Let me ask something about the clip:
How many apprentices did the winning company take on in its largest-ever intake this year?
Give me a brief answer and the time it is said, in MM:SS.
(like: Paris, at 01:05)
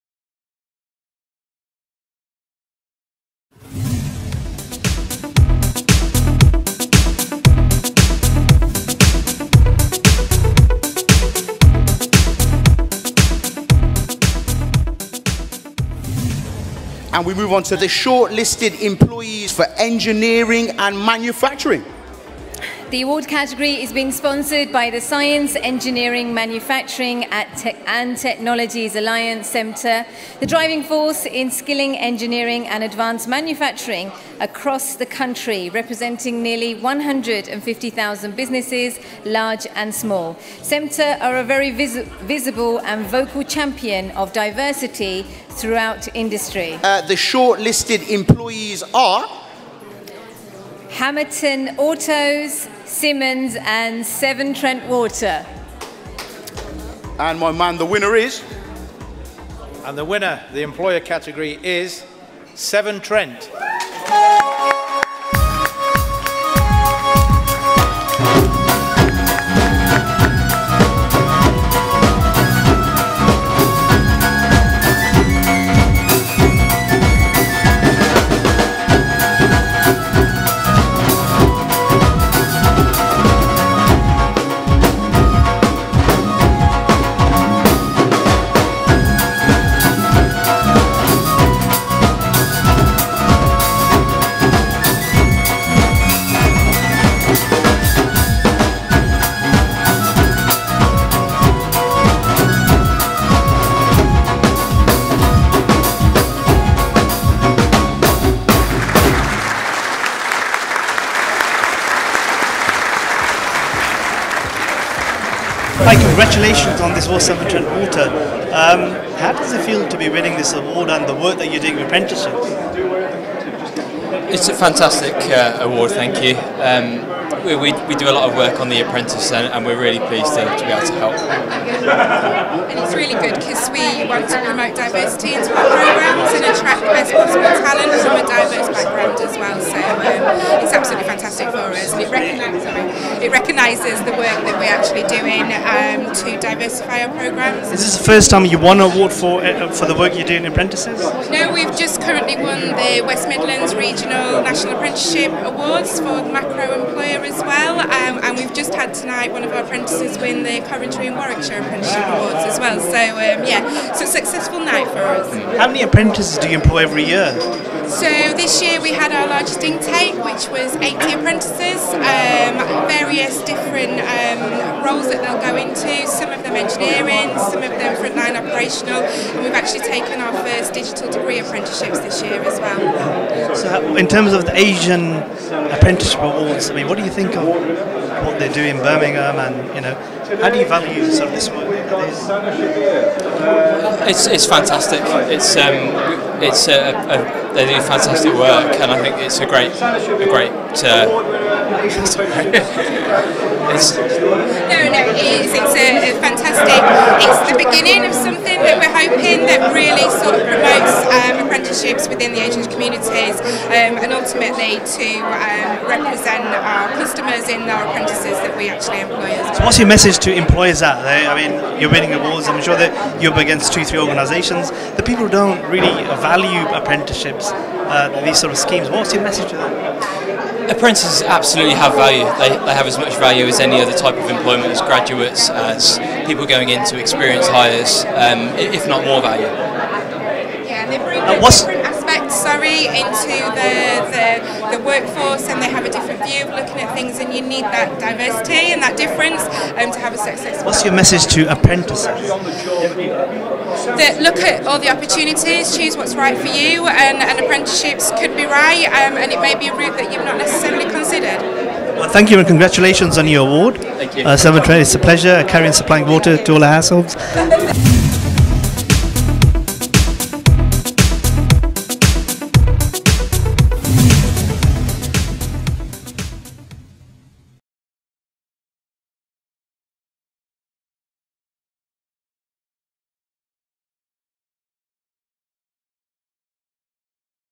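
80, at 02:50.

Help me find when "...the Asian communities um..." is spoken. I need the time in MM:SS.
03:32.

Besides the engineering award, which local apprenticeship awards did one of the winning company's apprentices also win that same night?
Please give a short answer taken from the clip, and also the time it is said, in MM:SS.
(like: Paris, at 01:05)
Coventry and Warwickshire Apprenticeship Awards, at 02:40.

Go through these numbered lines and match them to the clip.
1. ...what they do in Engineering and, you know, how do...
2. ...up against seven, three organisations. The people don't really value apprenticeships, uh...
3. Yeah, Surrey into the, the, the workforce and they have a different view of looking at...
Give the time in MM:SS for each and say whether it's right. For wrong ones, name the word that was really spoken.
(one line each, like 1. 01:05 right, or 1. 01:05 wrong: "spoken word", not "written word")
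1. 03:08 wrong: "Birmingham", not "Engineering"
2. 03:43 wrong: "two", not "seven"
3. 04:00 right.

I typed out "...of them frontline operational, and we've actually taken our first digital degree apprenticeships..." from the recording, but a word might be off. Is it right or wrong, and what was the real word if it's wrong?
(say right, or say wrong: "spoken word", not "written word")
right.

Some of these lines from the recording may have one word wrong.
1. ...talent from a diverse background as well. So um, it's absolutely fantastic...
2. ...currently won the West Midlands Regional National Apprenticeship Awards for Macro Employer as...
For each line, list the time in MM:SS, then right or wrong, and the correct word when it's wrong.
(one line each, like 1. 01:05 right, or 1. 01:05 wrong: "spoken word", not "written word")
1. 02:17 right
2. 02:32 right.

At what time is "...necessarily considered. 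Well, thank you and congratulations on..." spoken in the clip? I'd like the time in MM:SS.
04:20.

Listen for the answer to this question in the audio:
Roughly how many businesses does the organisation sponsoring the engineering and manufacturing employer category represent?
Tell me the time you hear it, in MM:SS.
00:36.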